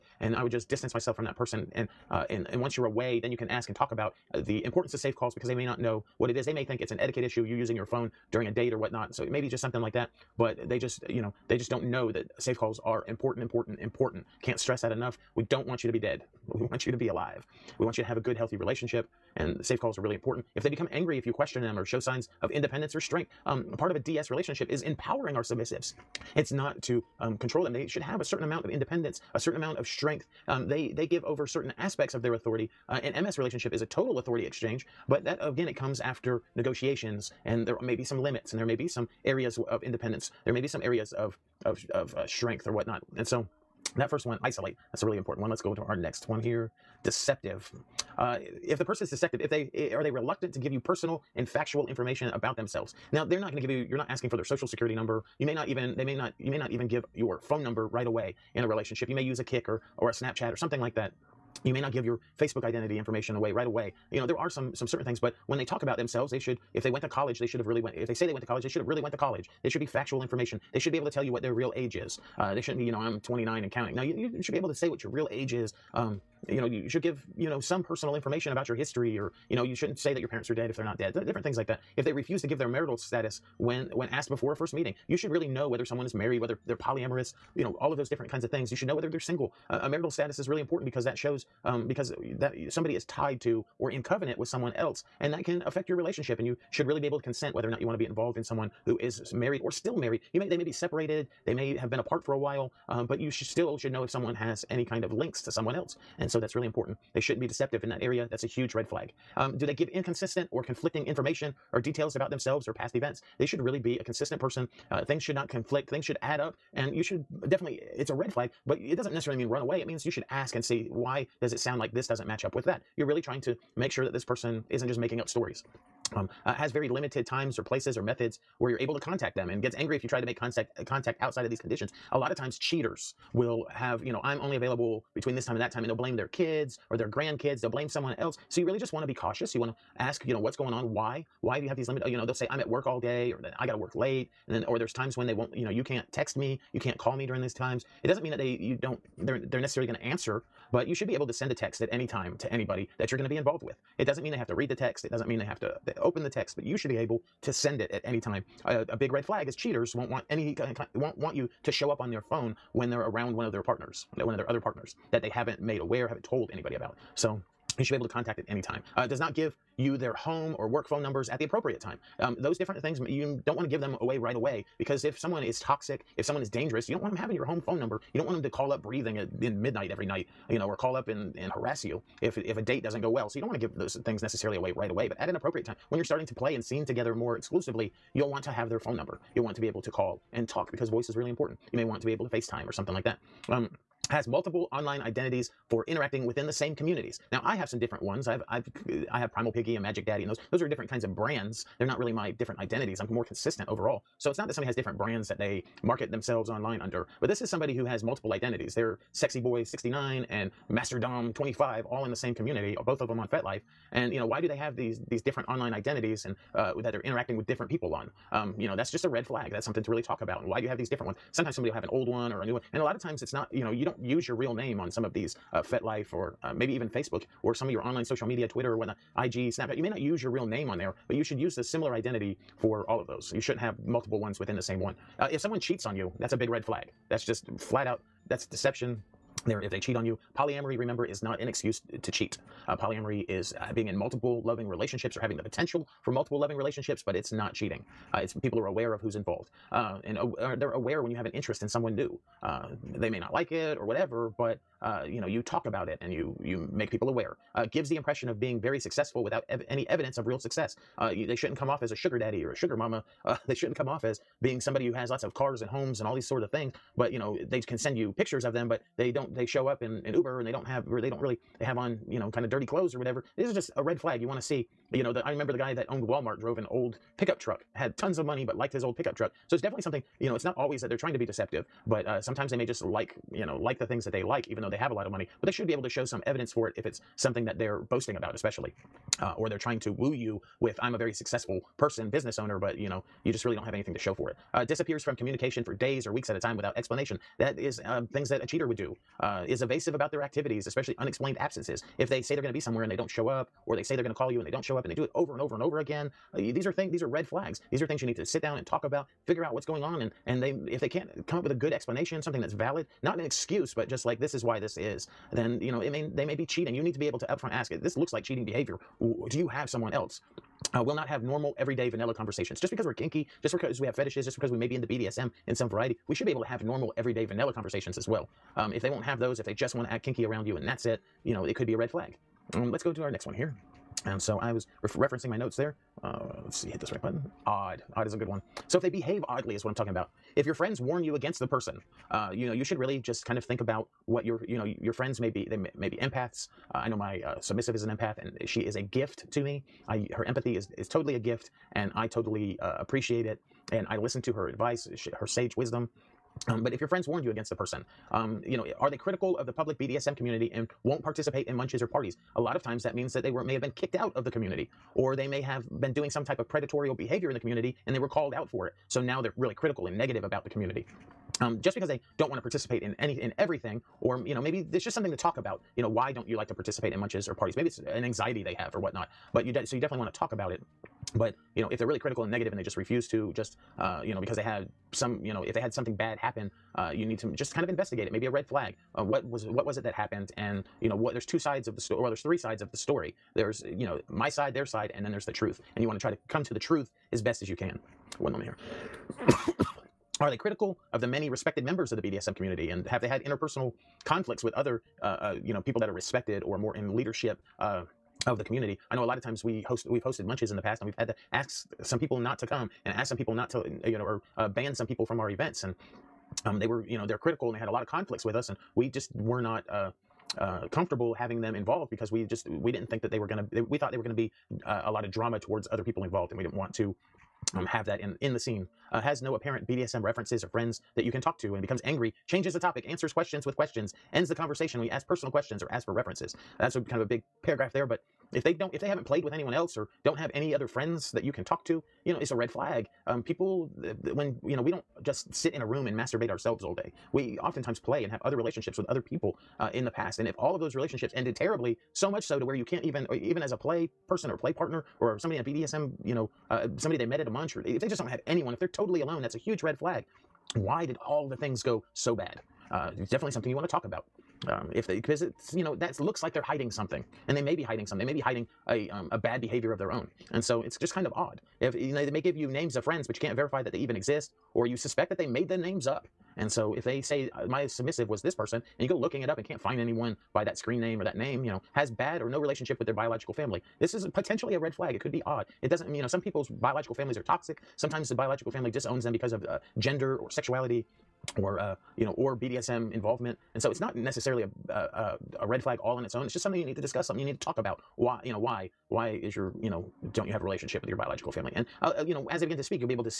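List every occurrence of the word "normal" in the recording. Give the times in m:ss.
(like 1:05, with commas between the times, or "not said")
5:21, 5:26.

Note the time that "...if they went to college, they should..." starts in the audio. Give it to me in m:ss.
1:06.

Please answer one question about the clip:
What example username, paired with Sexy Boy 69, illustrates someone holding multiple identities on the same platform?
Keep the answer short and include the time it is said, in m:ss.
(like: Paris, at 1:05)
Master Dom 25, at 3:30.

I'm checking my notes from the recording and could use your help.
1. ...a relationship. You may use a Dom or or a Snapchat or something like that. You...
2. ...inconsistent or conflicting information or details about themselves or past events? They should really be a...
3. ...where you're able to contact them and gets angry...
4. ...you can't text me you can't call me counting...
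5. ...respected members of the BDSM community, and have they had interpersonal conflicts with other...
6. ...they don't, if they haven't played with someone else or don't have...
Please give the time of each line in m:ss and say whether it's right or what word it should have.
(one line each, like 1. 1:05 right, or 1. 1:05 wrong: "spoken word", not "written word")
1. 0:58 wrong: "Kik", not "Dom"
2. 1:49 right
3. 2:08 right
4. 2:25 wrong: "during", not "counting"
5. 6:41 right
6. 7:18 wrong: "anyone", not "someone".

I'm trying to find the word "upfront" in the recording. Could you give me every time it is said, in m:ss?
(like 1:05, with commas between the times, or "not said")
5:17.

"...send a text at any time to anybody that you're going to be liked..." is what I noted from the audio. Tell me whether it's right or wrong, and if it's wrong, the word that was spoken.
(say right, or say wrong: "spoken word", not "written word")
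wrong: "involved", not "liked".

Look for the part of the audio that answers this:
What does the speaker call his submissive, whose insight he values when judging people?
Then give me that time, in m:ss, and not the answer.
5:47.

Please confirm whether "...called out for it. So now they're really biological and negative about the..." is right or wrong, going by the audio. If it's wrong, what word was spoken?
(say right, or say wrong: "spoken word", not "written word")
wrong: "critical", not "biological".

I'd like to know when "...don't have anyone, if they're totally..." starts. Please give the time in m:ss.
7:37.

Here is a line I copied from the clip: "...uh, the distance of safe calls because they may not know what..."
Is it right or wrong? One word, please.
wrong.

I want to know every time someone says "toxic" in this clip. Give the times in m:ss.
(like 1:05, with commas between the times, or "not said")
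2:55, 8:07.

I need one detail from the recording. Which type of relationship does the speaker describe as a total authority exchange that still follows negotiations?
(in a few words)
MS relationship.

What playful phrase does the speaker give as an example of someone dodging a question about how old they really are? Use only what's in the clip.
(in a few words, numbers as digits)
29 and counting.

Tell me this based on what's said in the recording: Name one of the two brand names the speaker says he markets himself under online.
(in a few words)
Primal Piggy.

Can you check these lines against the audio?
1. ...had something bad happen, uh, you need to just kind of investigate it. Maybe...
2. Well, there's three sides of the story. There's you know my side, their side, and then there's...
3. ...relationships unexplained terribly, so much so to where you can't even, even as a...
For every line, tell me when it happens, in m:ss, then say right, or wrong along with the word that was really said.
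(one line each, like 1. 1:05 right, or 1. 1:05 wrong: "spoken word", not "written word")
1. 6:25 right
2. 6:32 right
3. 7:30 wrong: "ended", not "unexplained".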